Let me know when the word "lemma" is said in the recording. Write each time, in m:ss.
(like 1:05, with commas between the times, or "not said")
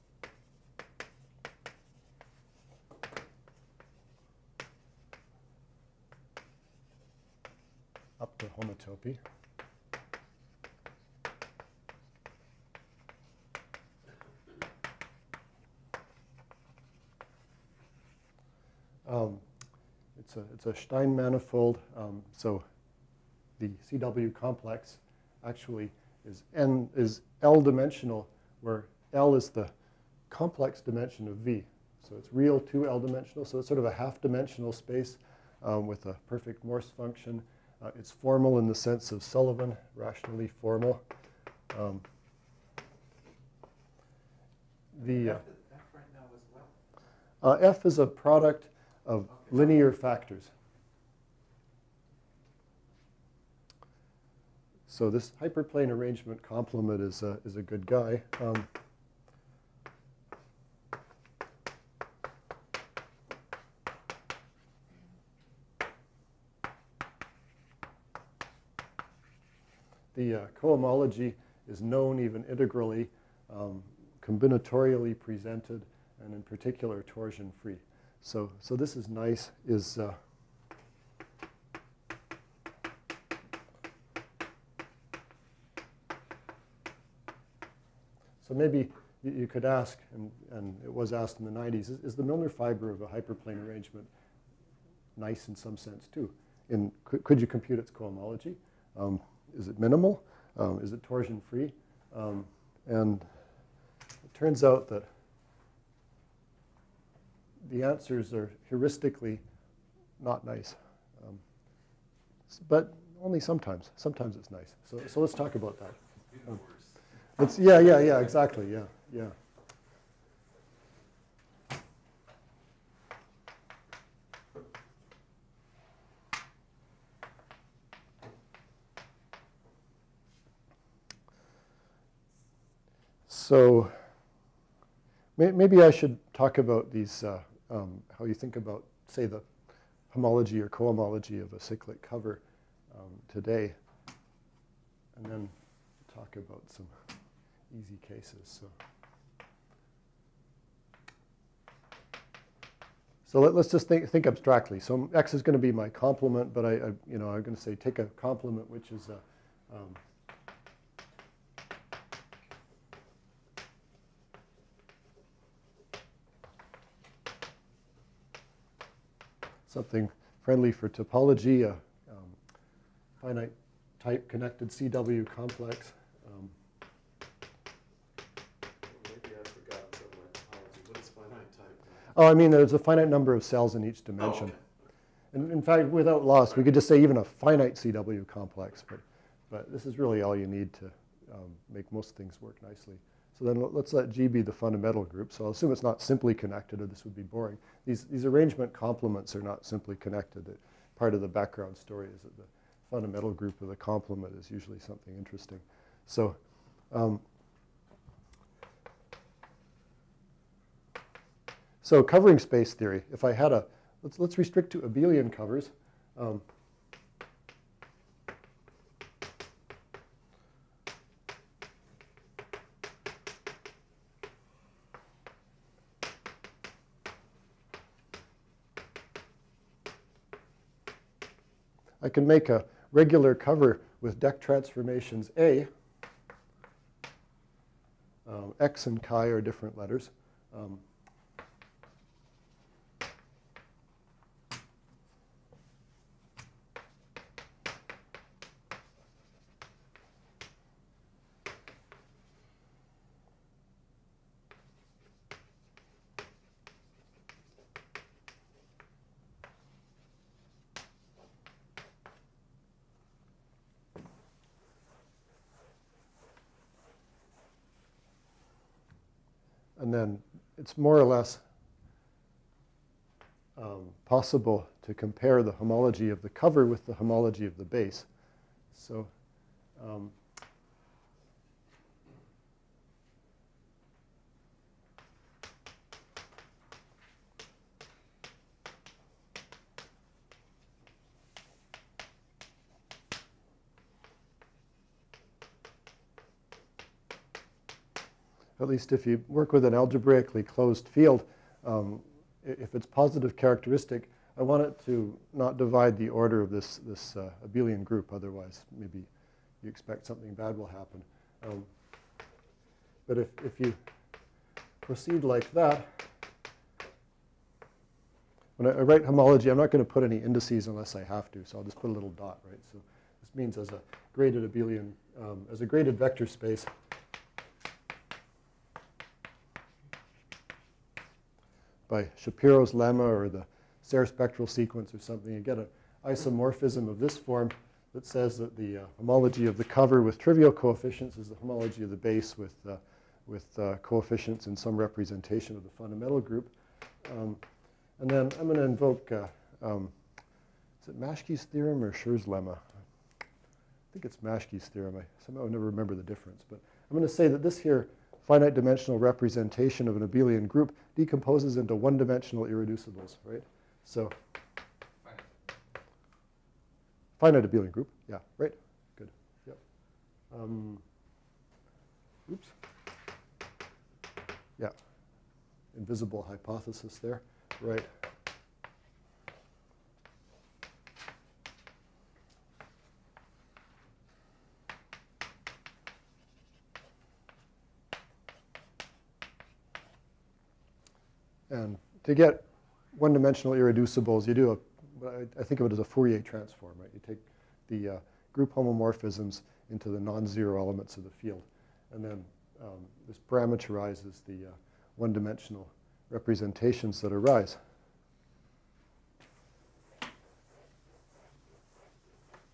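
5:32, 5:52.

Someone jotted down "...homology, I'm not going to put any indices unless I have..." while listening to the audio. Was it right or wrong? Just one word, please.
right.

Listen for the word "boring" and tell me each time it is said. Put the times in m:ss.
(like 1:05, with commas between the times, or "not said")
3:17.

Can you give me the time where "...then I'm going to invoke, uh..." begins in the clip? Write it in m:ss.
5:48.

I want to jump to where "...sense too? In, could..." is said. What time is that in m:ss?
1:35.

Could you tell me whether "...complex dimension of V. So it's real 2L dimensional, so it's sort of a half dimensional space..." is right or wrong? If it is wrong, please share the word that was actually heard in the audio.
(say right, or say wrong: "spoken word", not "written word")
right.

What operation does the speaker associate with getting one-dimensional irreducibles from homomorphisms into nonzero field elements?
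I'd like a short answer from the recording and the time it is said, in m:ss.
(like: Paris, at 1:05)
Fourier transform, at 6:35.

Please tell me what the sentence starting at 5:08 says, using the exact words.
Otherwise, maybe you expect something bad will happen.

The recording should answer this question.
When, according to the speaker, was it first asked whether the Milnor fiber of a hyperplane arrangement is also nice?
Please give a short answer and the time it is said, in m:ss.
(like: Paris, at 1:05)
the 90s, at 1:31.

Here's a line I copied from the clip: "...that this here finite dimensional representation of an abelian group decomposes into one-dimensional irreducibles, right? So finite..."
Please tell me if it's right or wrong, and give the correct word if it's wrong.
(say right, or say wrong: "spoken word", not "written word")
right.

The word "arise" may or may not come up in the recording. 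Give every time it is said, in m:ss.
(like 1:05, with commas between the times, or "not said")
6:47.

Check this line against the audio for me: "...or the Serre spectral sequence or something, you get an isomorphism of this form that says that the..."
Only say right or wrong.
right.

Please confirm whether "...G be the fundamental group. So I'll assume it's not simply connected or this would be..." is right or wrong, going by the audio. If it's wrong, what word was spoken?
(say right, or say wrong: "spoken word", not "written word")
right.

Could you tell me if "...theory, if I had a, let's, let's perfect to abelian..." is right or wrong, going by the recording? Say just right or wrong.
wrong.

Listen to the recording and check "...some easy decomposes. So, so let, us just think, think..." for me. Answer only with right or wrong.
wrong.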